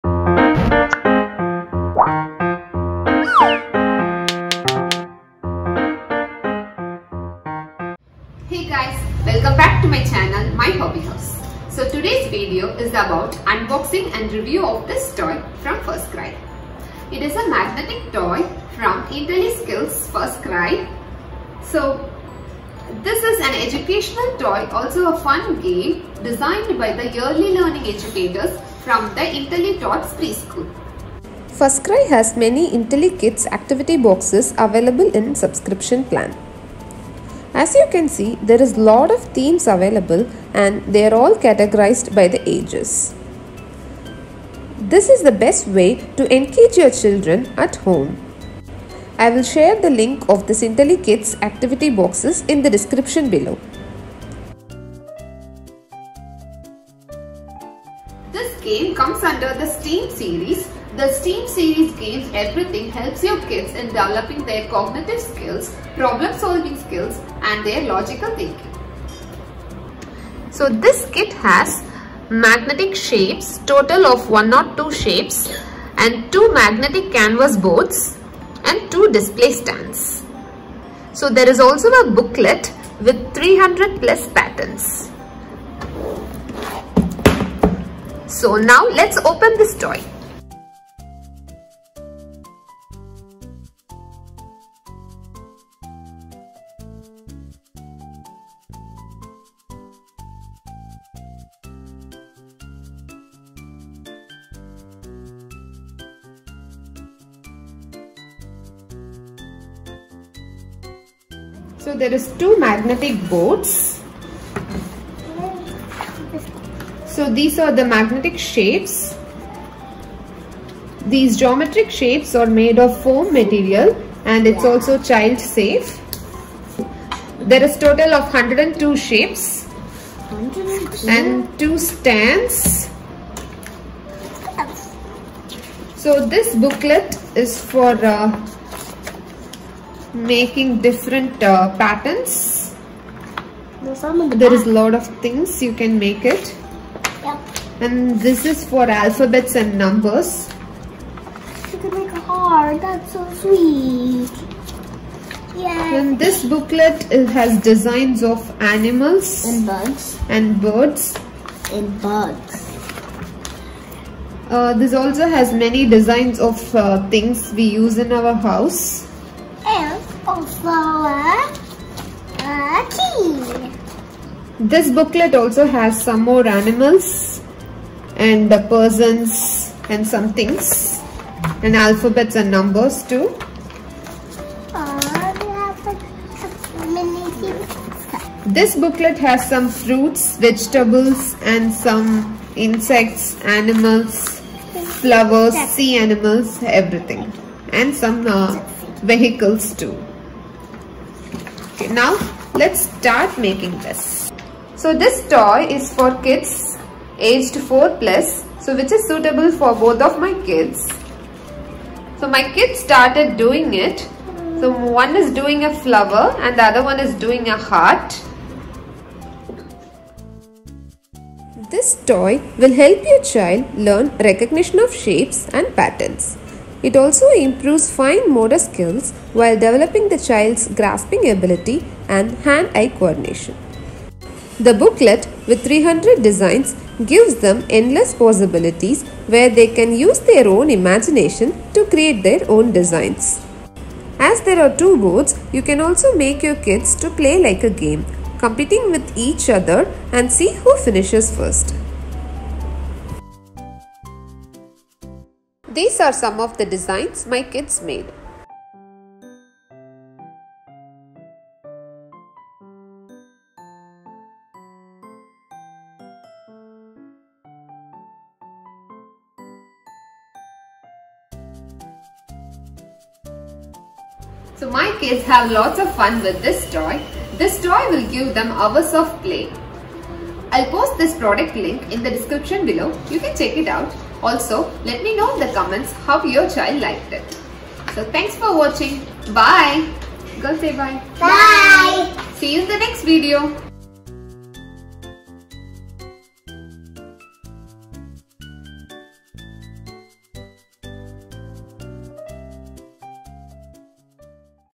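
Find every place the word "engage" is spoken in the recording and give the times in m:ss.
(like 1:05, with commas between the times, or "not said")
0:46.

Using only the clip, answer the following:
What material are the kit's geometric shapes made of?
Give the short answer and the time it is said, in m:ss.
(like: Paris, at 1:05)
foam, at 2:03.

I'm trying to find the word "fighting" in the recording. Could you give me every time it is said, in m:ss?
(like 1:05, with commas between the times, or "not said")
not said.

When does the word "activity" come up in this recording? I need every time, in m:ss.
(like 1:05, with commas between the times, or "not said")
0:33, 0:51.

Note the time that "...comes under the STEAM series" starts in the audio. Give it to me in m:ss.
0:58.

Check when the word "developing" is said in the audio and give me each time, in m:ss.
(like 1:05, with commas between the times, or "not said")
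1:03, 3:49.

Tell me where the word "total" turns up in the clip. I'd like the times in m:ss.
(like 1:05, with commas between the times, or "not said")
1:13, 2:07.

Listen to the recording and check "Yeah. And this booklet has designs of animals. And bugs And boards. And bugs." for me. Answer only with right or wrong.
wrong.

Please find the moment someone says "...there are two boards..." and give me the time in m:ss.
4:04.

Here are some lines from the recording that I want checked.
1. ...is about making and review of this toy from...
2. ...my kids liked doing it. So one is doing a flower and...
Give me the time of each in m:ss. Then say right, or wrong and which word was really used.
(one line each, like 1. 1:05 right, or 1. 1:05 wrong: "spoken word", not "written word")
1. 0:12 wrong: "unboxing", not "making"
2. 3:32 wrong: "started", not "liked".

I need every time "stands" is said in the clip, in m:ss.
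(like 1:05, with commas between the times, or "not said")
1:19, 2:11.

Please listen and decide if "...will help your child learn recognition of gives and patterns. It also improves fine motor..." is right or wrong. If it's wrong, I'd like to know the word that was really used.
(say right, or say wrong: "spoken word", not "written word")
wrong: "shapes", not "gives".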